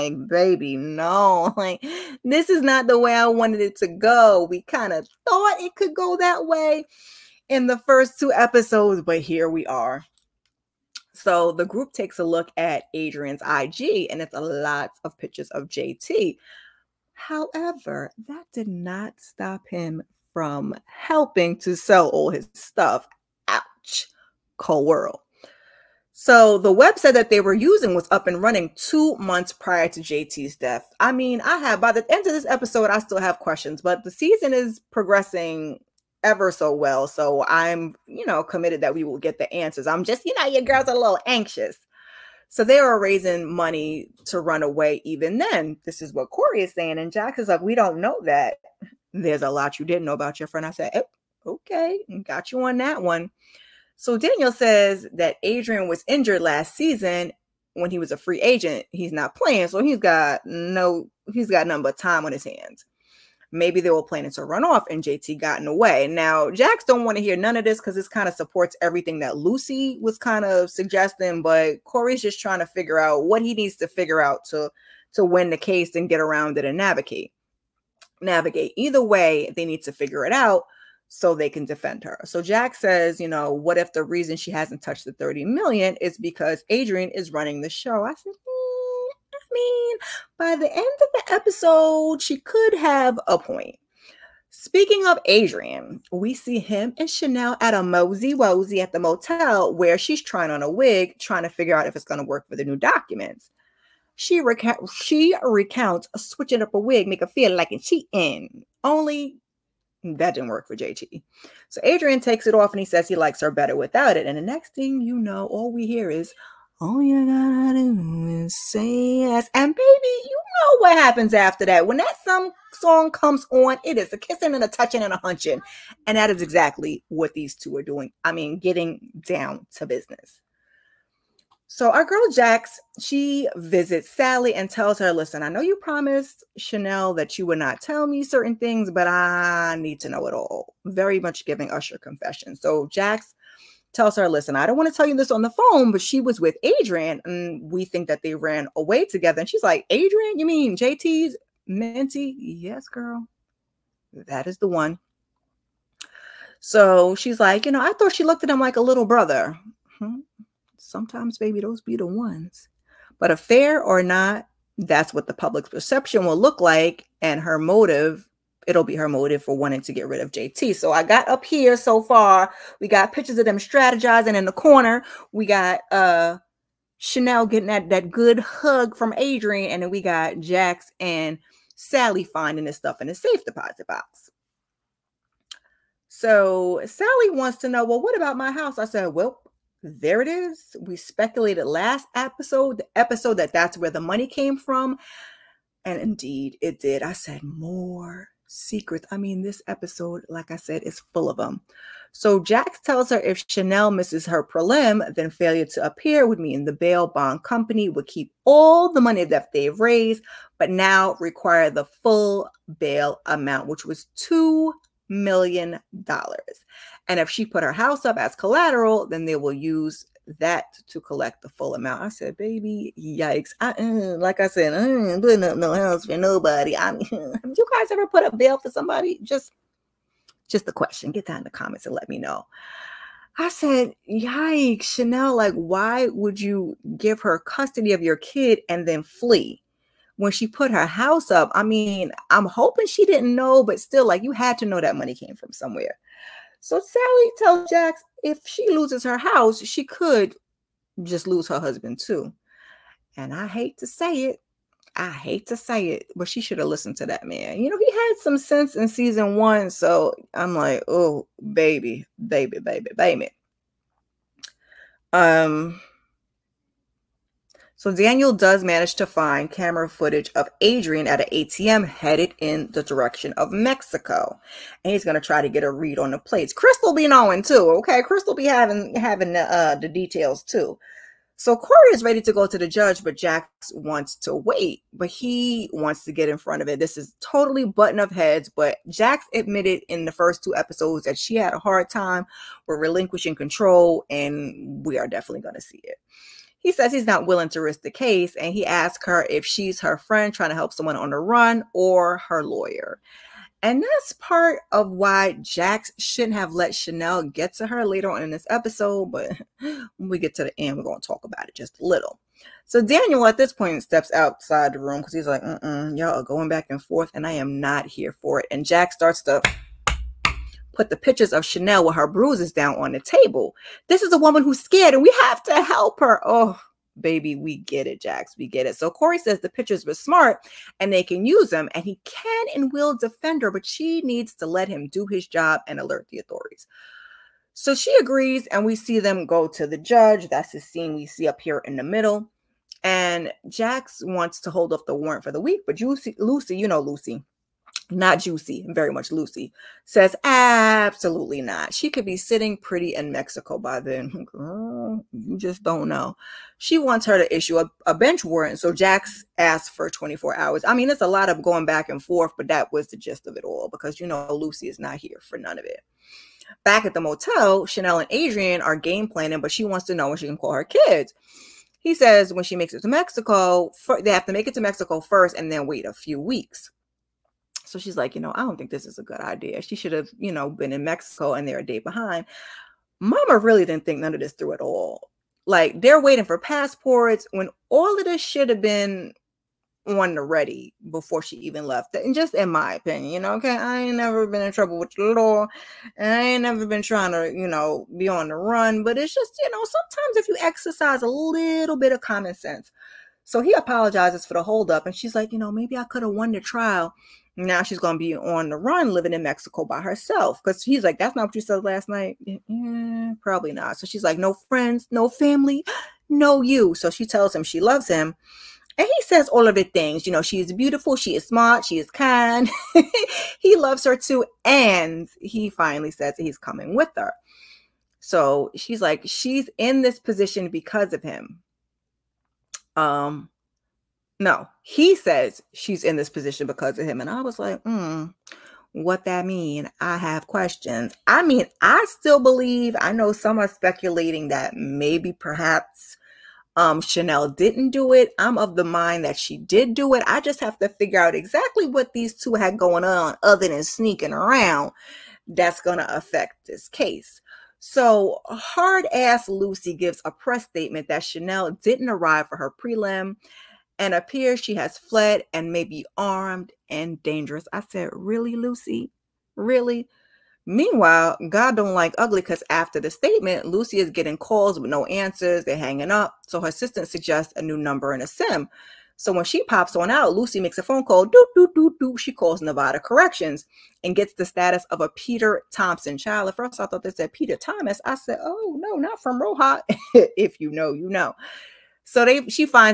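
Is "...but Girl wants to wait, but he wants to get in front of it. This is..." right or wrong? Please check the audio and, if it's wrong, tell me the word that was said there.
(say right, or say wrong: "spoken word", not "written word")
wrong: "Jax", not "Girl".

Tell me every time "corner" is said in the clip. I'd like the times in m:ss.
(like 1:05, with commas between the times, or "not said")
2:54.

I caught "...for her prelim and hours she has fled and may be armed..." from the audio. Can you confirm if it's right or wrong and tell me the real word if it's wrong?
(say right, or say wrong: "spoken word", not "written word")
wrong: "appears", not "hours".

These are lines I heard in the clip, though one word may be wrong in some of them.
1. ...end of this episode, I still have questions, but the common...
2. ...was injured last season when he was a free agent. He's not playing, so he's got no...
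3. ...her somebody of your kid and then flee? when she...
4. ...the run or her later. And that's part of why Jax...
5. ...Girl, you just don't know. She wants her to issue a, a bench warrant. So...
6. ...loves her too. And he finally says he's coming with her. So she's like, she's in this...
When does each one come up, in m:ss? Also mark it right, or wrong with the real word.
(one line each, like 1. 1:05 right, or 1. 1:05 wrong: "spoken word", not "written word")
1. 0:32 wrong: "season", not "common"
2. 0:55 right
3. 3:57 wrong: "custody", not "somebody"
4. 5:01 wrong: "lawyer", not "later"
5. 5:54 right
6. 7:03 right.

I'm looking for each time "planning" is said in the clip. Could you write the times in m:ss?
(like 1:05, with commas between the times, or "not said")
1:04, 6:09.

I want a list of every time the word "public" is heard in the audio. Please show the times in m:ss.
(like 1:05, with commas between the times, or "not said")
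2:45.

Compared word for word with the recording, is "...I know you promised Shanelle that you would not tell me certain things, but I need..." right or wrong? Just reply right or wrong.
right.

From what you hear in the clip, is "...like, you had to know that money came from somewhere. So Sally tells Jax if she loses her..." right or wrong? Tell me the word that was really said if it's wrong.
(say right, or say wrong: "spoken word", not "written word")
right.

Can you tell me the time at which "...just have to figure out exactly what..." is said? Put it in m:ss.
7:30.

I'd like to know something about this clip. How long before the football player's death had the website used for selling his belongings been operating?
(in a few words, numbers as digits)
2 months.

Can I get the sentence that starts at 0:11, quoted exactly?
So the group takes a look at Adrian's IG, and it's a lot of pictures of JT.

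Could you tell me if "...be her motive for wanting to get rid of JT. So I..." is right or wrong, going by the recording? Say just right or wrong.
right.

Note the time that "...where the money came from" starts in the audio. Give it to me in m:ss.
3:13.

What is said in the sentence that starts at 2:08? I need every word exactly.
I mean, getting down to business.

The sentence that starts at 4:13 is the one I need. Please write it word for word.
And I hate to say it, I hate to say it, but she should have listened to that man.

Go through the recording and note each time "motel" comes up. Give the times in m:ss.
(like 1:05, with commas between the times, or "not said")
1:38, 6:06.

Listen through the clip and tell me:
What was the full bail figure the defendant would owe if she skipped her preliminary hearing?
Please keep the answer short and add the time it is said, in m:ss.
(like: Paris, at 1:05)
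$2 million, at 3:34.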